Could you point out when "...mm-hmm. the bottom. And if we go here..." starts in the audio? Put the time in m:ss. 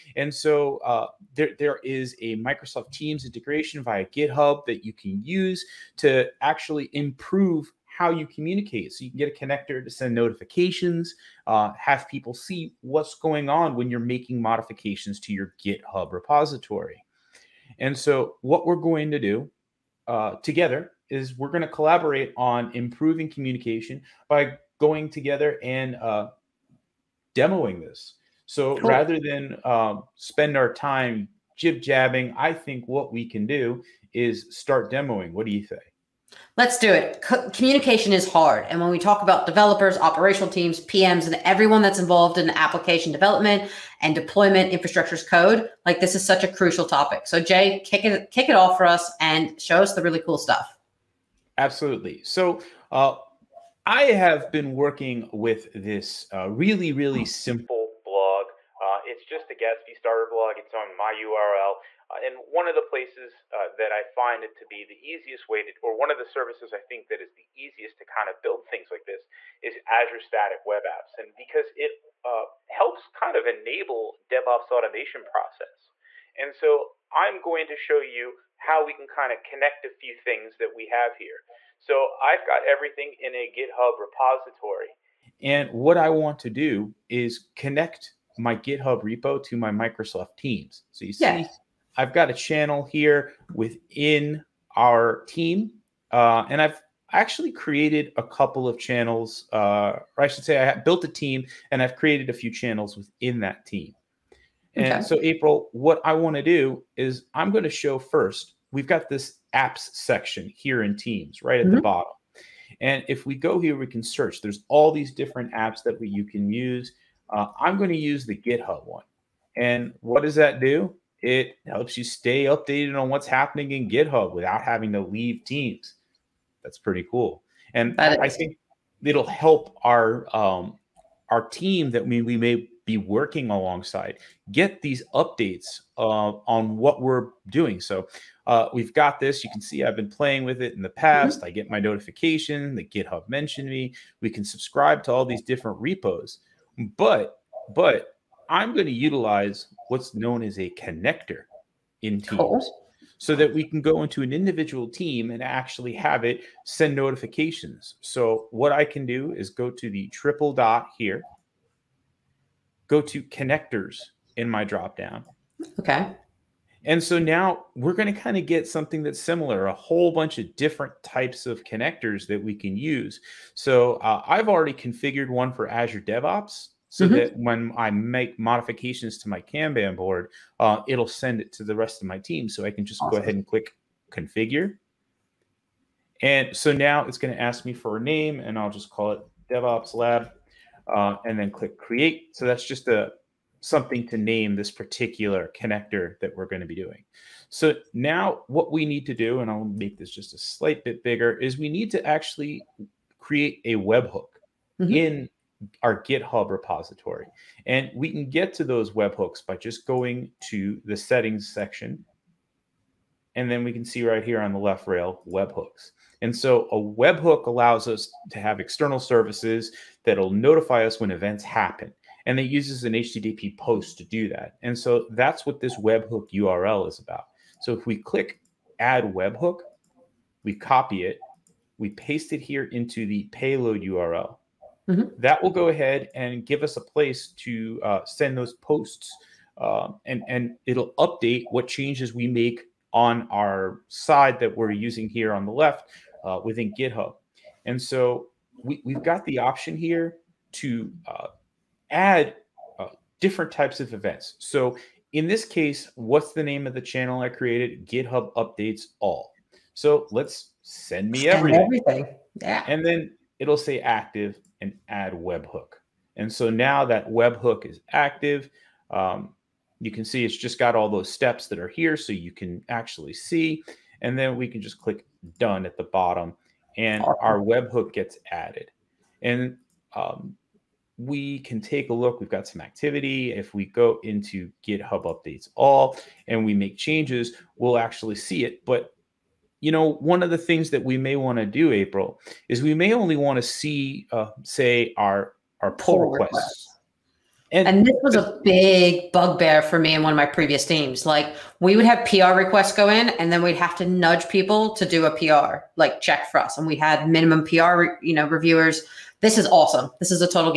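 1:51.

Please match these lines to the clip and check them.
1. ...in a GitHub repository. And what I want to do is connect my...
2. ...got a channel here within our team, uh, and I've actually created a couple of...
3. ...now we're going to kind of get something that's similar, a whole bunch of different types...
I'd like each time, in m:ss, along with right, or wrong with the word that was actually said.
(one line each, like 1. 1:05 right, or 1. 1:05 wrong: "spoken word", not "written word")
1. 1:23 right
2. 1:32 right
3. 2:47 right.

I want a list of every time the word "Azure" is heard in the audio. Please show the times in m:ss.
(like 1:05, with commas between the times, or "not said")
1:09, 2:55.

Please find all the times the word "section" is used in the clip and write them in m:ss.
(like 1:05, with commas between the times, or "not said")
1:49, 3:31.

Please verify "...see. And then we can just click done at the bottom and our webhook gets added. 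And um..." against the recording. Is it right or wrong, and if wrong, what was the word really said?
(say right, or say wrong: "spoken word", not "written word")
right.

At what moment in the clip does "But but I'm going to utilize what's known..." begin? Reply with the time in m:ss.
2:26.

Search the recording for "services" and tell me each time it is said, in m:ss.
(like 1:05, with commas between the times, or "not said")
1:06, 3:38.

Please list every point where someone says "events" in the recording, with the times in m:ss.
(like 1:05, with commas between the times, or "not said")
3:41, 4:13.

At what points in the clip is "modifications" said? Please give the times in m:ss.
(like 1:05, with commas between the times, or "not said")
0:14, 2:58.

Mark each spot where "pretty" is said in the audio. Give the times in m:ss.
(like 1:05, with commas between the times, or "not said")
2:06.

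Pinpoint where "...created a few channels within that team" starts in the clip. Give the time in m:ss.
1:41.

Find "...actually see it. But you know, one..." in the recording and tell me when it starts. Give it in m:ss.
4:47.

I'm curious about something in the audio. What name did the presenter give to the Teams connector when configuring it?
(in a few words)
DevOps Lab.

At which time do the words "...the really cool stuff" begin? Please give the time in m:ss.
0:49.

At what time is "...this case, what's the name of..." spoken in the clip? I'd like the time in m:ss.
4:15.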